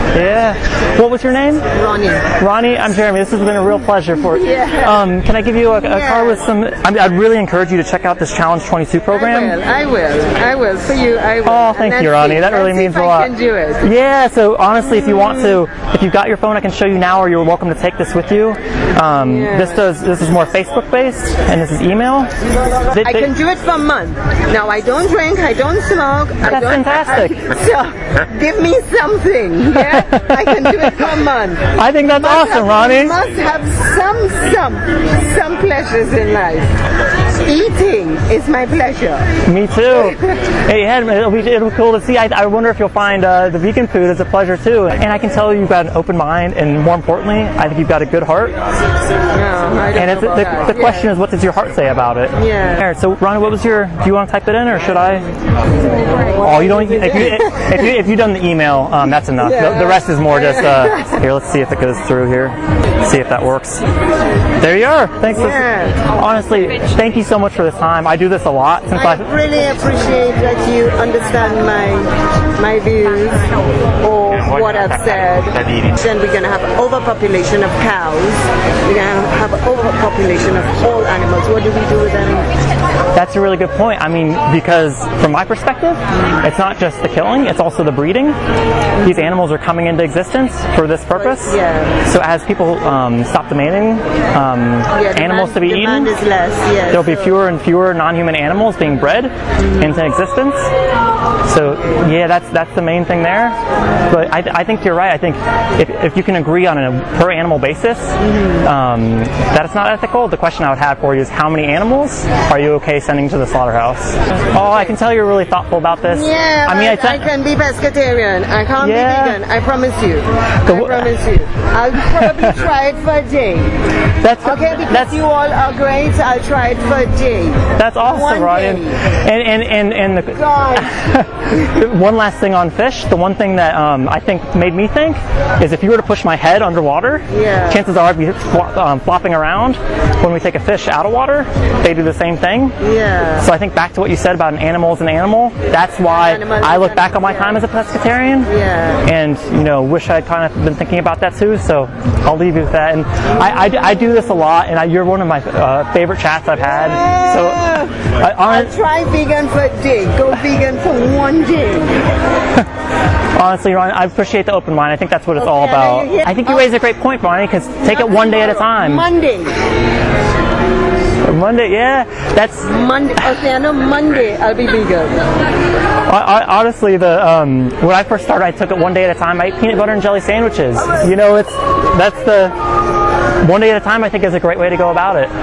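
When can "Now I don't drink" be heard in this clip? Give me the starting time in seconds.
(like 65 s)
24 s.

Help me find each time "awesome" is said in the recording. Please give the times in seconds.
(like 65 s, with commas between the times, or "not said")
32 s, 127 s.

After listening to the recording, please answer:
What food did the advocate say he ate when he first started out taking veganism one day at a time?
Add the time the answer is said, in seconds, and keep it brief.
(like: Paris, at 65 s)
Peanut butter and jelly sandwiches, at 179 s.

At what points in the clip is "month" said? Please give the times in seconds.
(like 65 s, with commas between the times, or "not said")
23 s, 31 s.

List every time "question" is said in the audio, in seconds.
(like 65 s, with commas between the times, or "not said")
50 s, 110 s.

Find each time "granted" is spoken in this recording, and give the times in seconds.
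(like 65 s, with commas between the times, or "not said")
not said.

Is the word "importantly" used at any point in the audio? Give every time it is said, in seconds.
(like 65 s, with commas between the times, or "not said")
46 s.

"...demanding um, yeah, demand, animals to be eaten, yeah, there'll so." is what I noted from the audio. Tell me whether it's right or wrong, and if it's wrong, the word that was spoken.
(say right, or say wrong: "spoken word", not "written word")
right.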